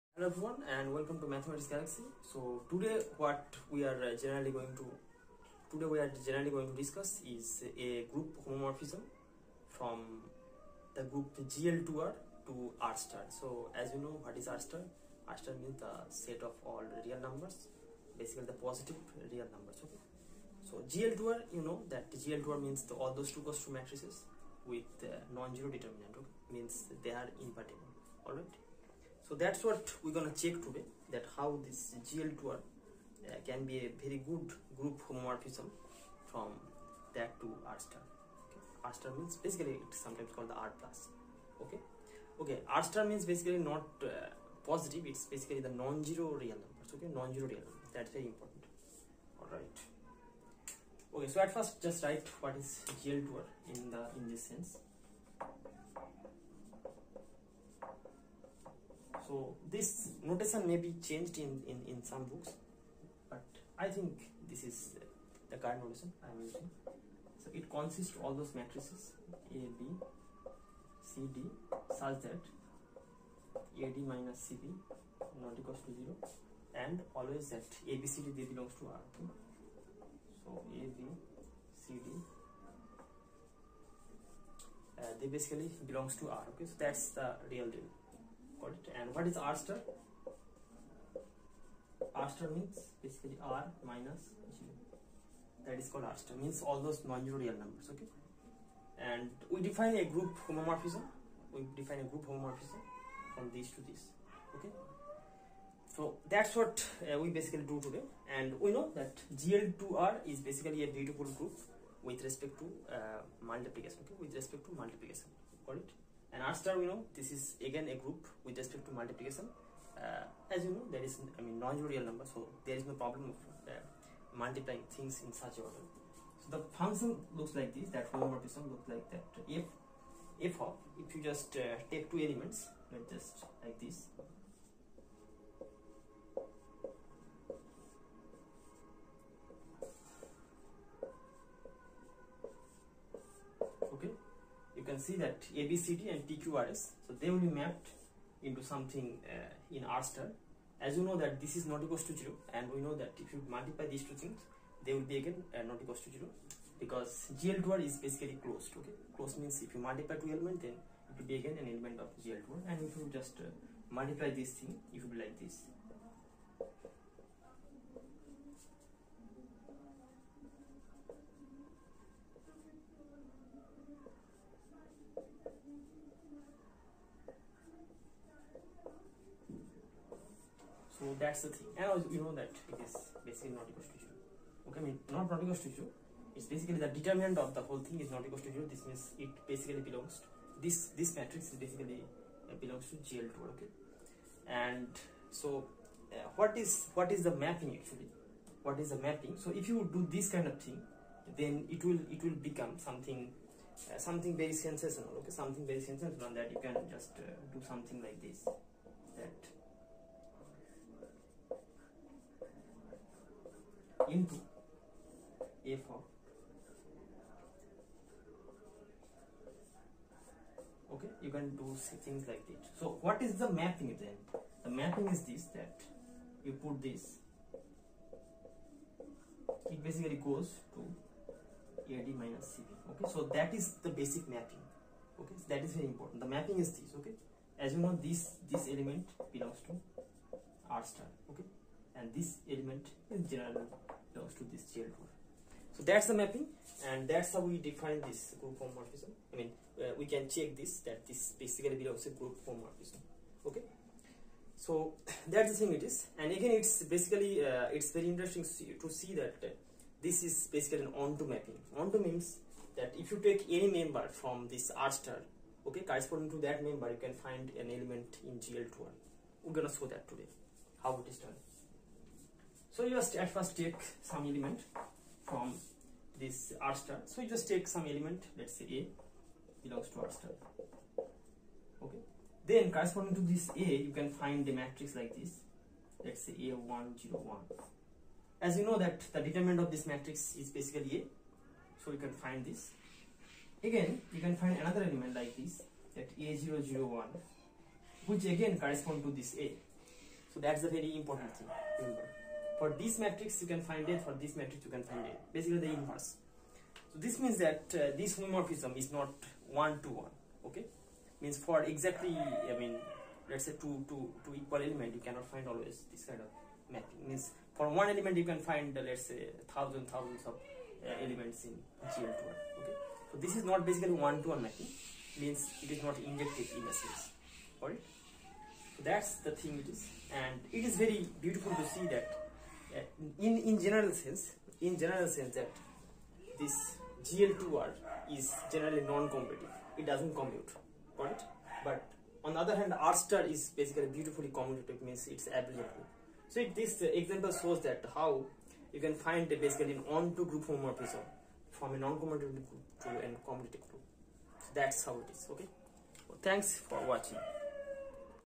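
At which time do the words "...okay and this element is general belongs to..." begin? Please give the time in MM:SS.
04:01.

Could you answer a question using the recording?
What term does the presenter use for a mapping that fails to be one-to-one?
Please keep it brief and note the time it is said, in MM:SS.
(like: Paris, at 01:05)
not injective, at 05:25.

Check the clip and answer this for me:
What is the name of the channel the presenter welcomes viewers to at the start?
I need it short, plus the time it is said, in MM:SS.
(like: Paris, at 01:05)
Mathematics Galaxy, at 00:01.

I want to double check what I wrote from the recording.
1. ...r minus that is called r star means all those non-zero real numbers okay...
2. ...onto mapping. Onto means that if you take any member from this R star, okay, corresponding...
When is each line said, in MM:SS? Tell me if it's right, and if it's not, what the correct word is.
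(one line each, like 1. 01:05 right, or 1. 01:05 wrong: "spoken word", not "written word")
1. 01:33 right
2. 04:20 right.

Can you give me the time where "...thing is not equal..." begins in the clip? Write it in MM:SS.
03:07.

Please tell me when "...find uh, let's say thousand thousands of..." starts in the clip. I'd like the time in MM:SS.
05:18.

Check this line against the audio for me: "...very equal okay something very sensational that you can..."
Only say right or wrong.
wrong.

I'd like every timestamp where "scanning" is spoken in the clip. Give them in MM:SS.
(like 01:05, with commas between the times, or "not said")
not said.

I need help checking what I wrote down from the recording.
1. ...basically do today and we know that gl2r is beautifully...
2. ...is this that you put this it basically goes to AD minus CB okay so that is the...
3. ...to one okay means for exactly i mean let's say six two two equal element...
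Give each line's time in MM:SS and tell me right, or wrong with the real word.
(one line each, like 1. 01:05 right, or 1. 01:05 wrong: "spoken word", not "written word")
1. 01:47 wrong: "basically", not "beautifully"
2. 03:45 right
3. 05:09 wrong: "two", not "six".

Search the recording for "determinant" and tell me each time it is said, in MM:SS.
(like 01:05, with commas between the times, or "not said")
00:25, 03:06, 04:49.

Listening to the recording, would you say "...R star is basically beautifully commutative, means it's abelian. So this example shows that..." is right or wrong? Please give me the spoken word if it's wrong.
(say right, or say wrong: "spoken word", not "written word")
right.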